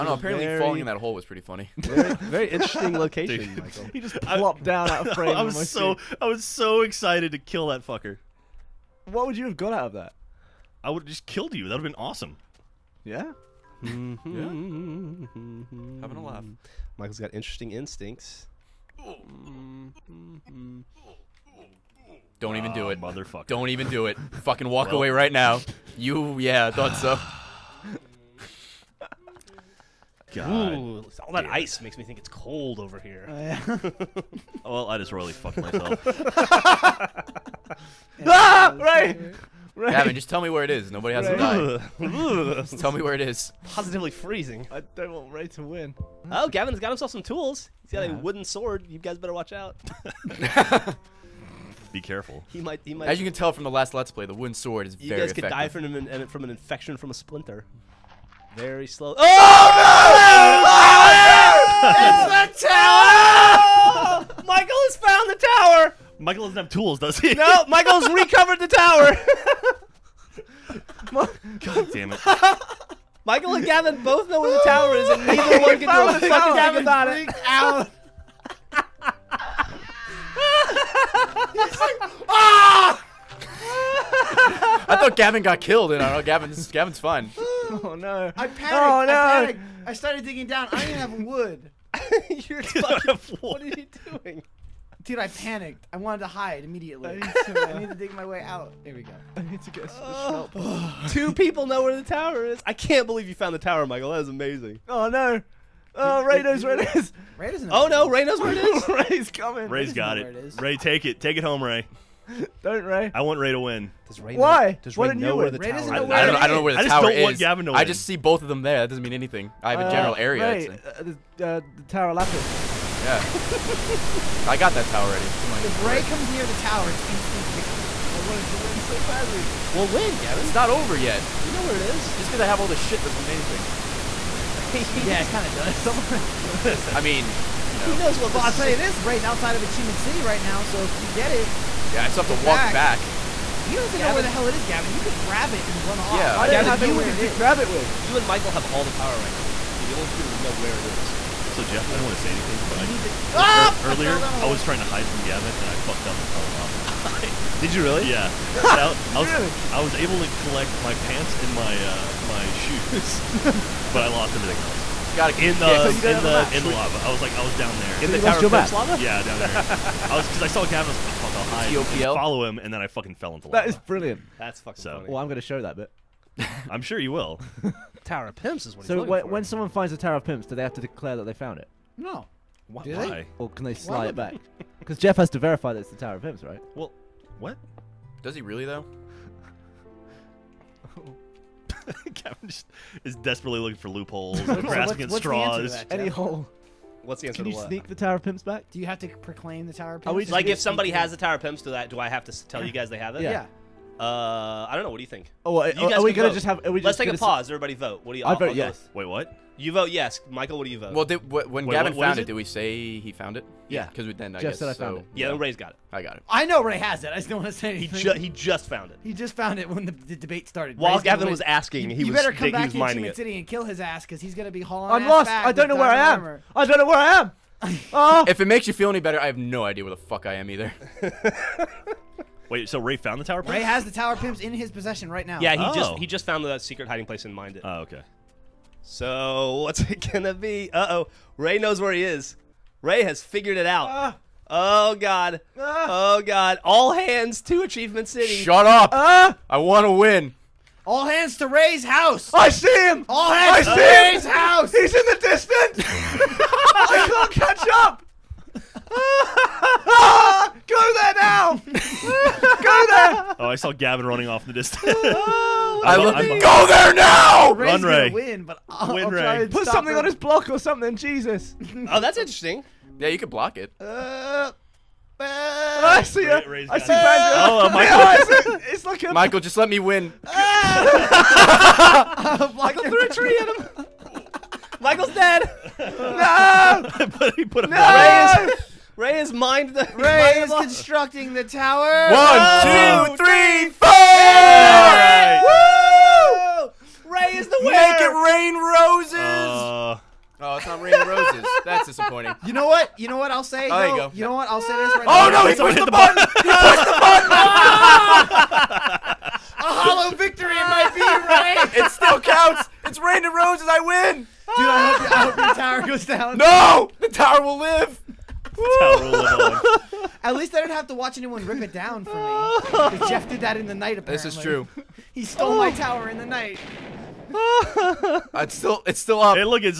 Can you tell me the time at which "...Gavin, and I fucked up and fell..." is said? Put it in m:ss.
2:35.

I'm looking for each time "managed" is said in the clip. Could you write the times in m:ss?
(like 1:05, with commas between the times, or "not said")
not said.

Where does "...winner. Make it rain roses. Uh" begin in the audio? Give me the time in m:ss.
4:57.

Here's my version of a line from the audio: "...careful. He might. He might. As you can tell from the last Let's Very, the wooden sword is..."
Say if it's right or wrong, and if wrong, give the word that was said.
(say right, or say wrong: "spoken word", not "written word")
wrong: "Play", not "Very".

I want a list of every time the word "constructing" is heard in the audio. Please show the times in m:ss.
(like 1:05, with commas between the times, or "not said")
4:50.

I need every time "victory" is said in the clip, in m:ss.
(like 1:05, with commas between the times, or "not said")
2:07, 5:10.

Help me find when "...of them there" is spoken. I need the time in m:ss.
1:58.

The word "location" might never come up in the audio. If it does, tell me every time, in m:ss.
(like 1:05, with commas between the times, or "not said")
0:02.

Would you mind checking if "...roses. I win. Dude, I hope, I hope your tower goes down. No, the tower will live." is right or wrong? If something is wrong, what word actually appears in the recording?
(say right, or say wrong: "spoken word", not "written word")
right.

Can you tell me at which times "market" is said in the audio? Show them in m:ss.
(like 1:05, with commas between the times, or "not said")
not said.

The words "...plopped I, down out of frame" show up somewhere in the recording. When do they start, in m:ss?
0:04.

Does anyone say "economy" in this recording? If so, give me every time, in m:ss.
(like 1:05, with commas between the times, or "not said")
not said.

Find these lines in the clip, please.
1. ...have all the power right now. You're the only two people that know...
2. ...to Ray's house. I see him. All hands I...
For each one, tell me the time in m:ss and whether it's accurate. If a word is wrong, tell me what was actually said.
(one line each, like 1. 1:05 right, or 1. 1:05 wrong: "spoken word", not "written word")
1. 2:28 right
2. 4:11 right.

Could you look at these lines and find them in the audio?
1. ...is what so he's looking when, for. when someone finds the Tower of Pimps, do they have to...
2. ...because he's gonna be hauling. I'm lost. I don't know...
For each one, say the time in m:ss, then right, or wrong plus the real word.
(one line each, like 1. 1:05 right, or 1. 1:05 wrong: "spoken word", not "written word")
1. 2:58 right
2. 3:44 right.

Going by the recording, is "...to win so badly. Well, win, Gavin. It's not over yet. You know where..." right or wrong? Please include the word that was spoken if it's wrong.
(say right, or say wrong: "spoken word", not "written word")
right.